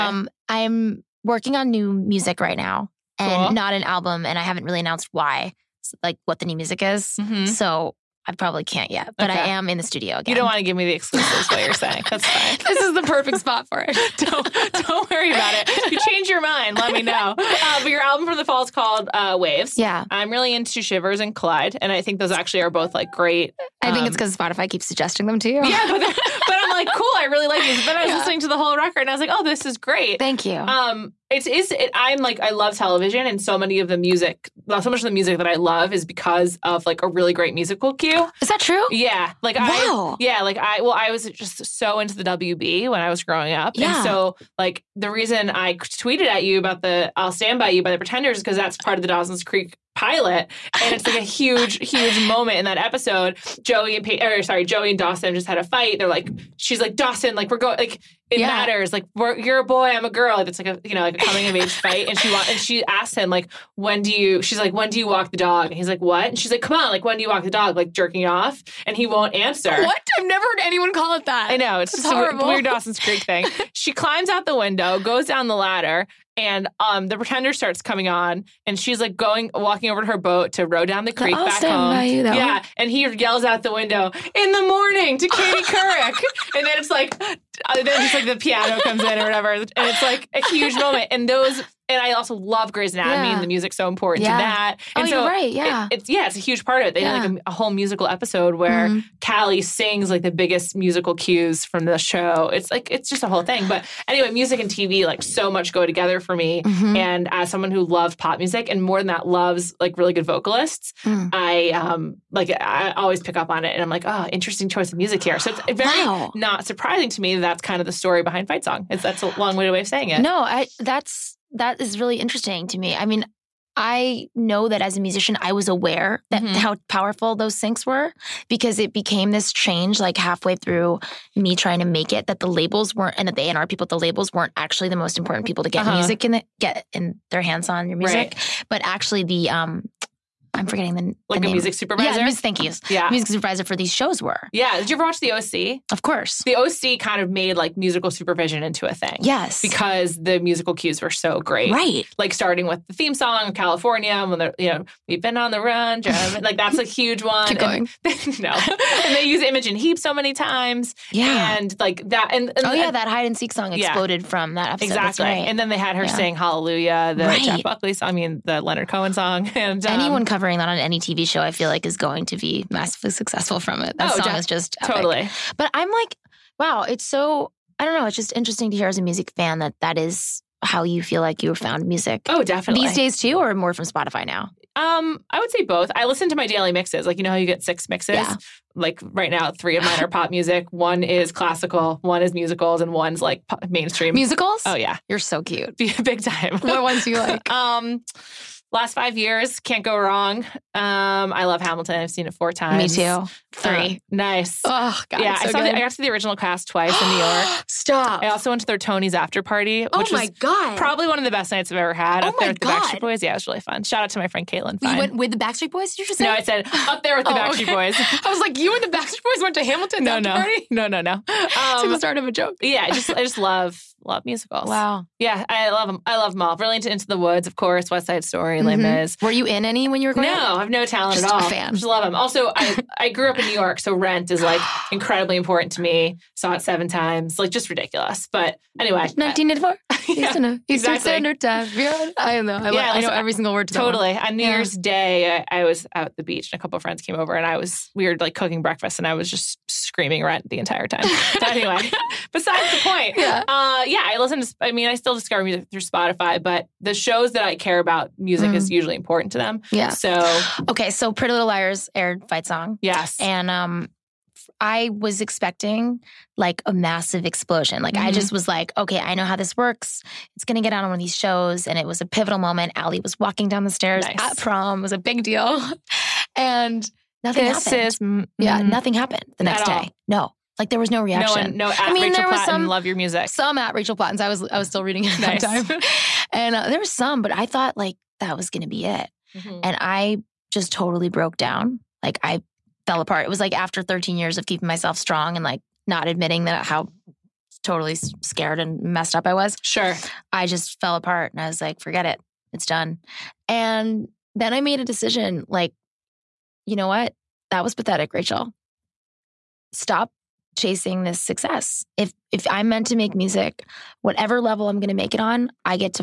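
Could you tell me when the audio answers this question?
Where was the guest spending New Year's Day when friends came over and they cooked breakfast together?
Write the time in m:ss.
4:06.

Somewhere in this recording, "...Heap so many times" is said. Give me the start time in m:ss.
2:39.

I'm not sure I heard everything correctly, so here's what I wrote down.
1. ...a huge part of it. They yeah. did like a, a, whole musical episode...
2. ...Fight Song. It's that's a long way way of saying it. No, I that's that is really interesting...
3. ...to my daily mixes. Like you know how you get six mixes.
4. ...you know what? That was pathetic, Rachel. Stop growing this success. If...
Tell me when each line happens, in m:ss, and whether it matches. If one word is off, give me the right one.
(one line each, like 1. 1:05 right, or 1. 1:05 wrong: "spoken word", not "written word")
1. 1:36 right
2. 1:58 right
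3. 3:06 right
4. 5:06 wrong: "chasing", not "growing".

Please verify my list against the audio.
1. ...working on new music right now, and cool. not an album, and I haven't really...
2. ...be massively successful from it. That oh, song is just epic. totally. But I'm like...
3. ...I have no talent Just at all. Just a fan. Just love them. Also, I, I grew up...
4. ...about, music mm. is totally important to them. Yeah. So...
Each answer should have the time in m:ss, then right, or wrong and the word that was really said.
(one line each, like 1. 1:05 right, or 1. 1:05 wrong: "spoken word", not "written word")
1. 0:01 right
2. 2:52 right
3. 3:50 right
4. 4:17 wrong: "usually", not "totally".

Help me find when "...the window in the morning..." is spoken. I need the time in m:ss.
1:23.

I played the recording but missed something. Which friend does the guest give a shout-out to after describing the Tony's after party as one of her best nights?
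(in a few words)
Caitlin.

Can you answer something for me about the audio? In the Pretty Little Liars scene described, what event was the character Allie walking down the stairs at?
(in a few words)
Prom.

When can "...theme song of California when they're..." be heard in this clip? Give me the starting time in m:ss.
2:32.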